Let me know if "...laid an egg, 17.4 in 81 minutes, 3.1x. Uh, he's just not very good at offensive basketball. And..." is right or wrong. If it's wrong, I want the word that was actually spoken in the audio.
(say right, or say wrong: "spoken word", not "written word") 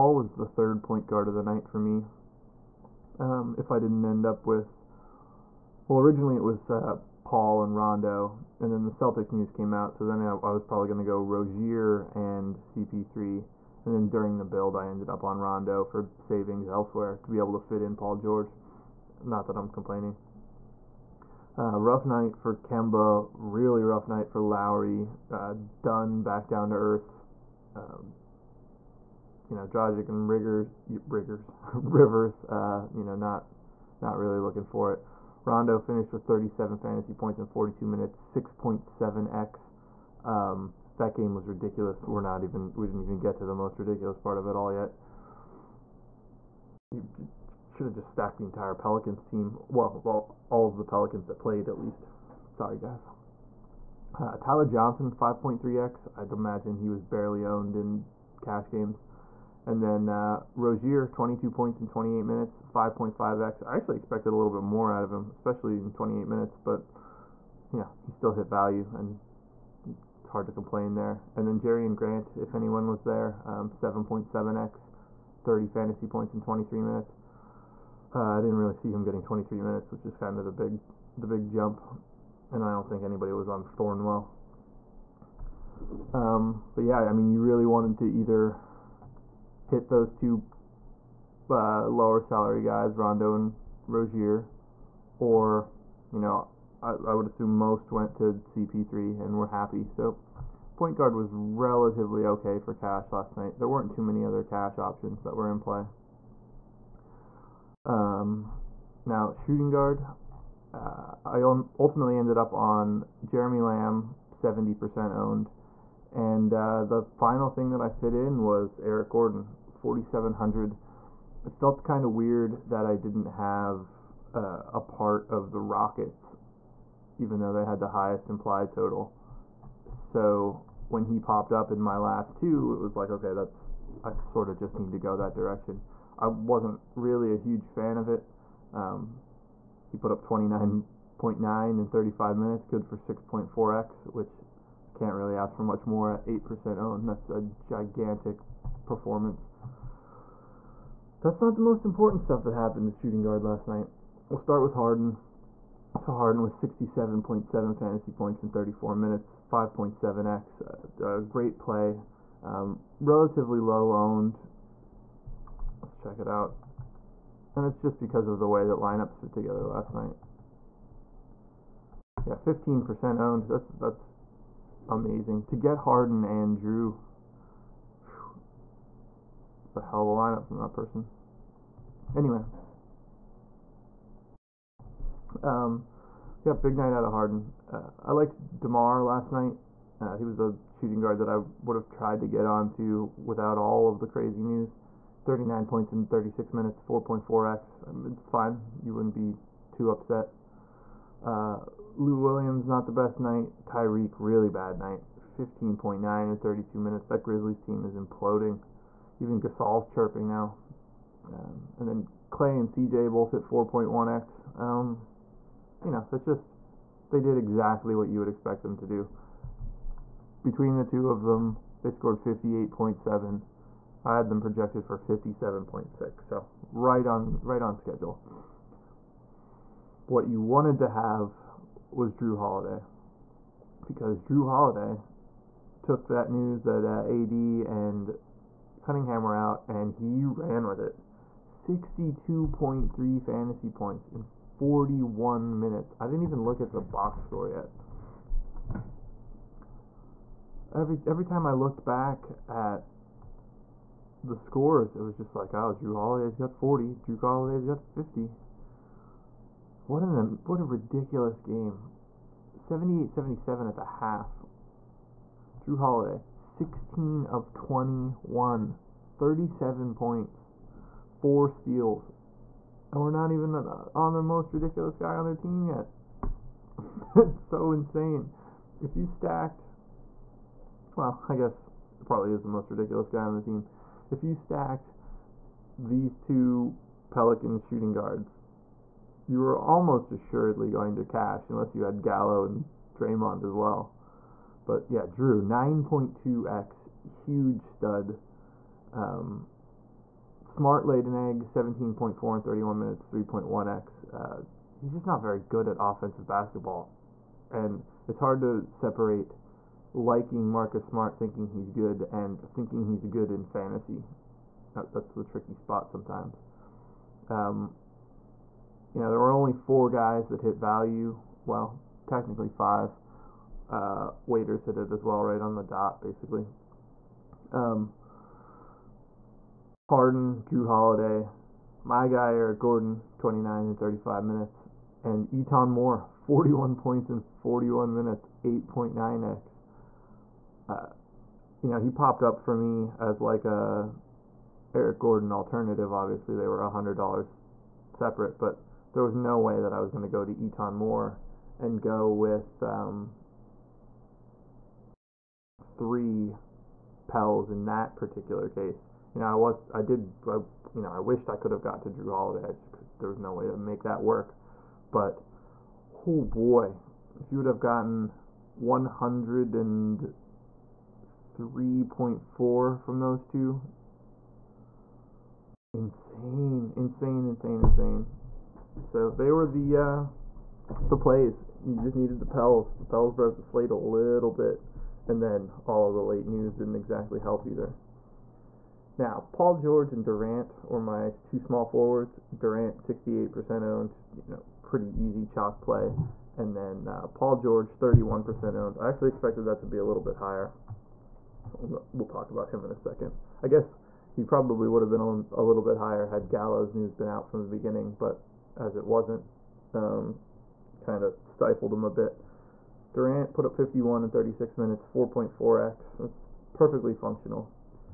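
wrong: "31", not "81".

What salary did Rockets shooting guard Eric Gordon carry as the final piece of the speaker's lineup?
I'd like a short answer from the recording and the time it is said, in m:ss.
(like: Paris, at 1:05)
4700, at 1:59.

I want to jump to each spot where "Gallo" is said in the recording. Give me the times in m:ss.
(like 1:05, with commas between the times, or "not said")
4:52, 6:46.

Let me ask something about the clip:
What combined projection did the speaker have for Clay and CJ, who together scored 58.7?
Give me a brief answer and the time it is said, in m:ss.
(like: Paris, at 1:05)
57.6, at 3:44.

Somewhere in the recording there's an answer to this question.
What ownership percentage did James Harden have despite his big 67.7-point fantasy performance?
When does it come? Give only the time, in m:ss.
2:52.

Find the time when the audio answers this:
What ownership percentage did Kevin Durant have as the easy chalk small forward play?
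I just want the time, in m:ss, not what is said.
6:32.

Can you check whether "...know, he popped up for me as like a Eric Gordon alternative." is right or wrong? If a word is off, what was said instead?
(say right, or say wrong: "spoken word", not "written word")
right.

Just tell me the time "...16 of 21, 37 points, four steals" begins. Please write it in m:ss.
4:26.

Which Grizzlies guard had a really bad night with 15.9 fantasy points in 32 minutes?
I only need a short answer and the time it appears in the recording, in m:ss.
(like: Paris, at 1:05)
Tyreke, at 3:23.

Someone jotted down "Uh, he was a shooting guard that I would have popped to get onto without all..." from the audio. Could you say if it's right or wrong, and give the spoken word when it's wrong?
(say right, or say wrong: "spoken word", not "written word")
wrong: "tried", not "popped".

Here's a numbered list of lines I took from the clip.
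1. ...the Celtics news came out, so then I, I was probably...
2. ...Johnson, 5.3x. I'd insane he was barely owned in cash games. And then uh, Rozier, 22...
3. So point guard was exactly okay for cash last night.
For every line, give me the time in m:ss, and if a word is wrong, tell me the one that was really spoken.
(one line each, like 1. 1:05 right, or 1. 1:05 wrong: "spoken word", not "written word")
1. 0:08 right
2. 0:54 wrong: "imagine", not "insane"
3. 1:39 wrong: "relatively", not "exactly".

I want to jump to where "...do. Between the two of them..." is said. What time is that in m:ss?
3:38.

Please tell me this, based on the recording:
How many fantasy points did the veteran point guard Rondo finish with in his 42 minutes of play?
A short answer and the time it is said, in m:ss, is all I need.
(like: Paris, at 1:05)
37, at 0:36.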